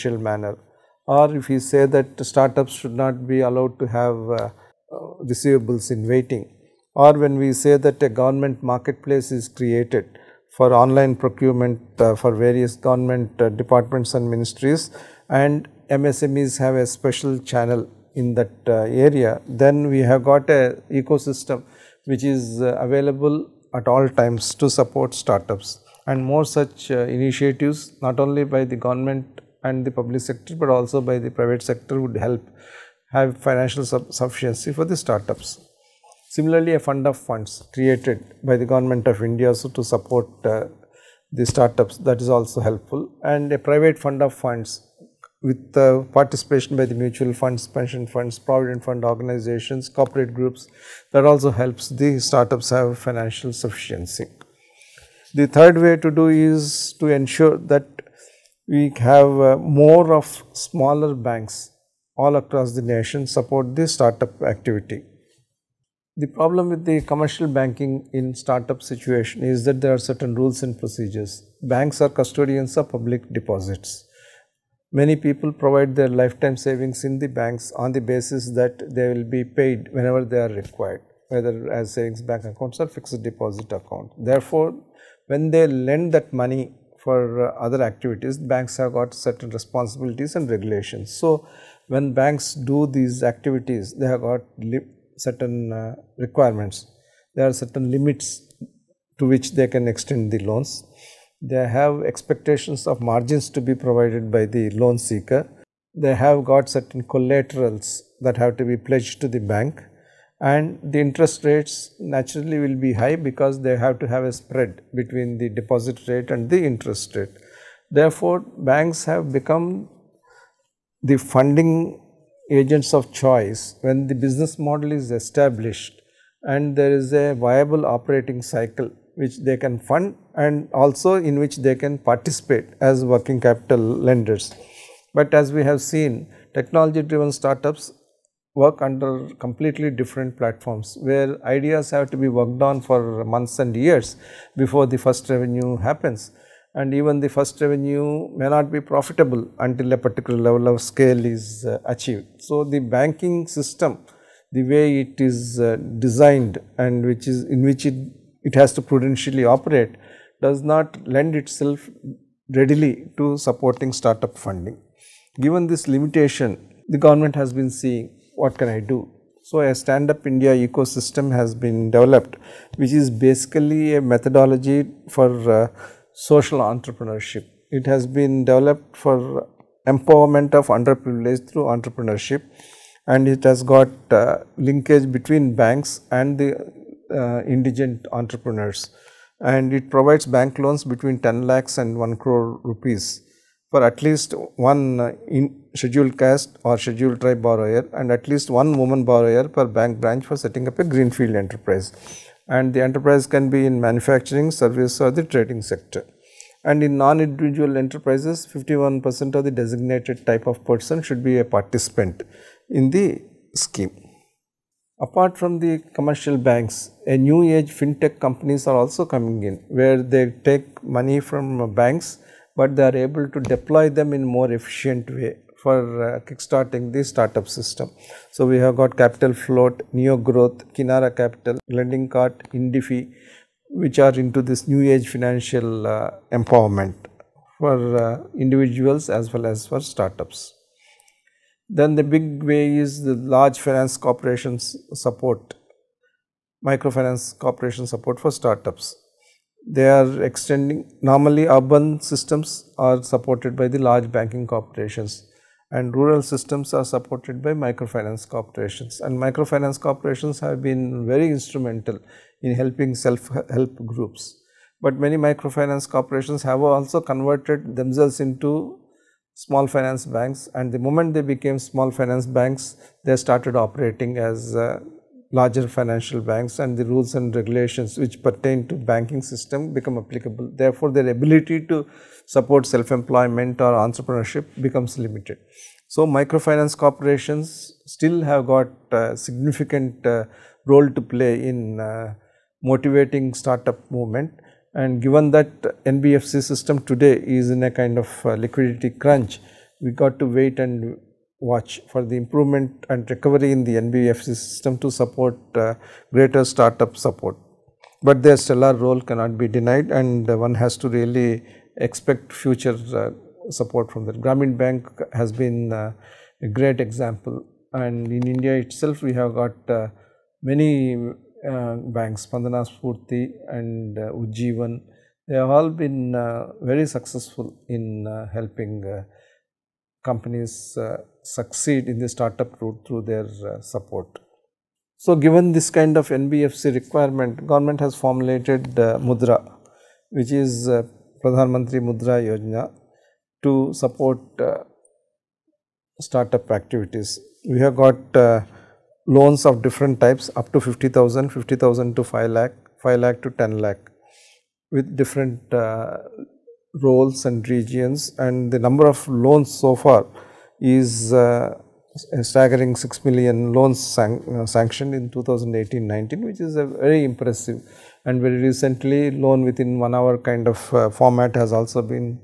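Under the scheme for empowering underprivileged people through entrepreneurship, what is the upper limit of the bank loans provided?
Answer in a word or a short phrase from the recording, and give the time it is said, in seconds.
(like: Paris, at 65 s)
1 crore rupees, at 191 s.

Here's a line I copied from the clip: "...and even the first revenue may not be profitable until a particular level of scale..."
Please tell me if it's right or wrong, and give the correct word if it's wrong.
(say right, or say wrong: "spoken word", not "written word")
right.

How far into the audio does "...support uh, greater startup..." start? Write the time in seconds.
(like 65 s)
304 s.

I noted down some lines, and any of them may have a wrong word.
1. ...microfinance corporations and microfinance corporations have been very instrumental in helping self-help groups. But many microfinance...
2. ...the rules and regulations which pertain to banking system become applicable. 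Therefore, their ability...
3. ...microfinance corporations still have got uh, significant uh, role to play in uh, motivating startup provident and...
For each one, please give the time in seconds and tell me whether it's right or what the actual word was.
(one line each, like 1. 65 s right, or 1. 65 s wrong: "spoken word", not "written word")
1. 257 s right
2. 276 s right
3. 286 s wrong: "movement", not "provident".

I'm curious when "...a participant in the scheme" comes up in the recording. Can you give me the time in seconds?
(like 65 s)
211 s.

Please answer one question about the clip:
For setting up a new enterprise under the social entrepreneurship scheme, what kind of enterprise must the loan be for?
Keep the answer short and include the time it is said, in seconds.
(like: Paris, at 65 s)
greenfield enterprise, at 200 s.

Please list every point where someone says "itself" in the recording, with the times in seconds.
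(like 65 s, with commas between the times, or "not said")
161 s, 318 s.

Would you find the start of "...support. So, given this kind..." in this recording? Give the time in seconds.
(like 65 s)
333 s.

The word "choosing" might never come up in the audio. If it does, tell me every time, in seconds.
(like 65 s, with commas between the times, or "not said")
not said.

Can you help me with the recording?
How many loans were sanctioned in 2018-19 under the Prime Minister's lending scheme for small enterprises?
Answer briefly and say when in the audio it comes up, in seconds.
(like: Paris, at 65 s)
6 million, at 362 s.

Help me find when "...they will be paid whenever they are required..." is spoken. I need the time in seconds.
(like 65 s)
78 s.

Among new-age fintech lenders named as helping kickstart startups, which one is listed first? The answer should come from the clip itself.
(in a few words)
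Capital Float.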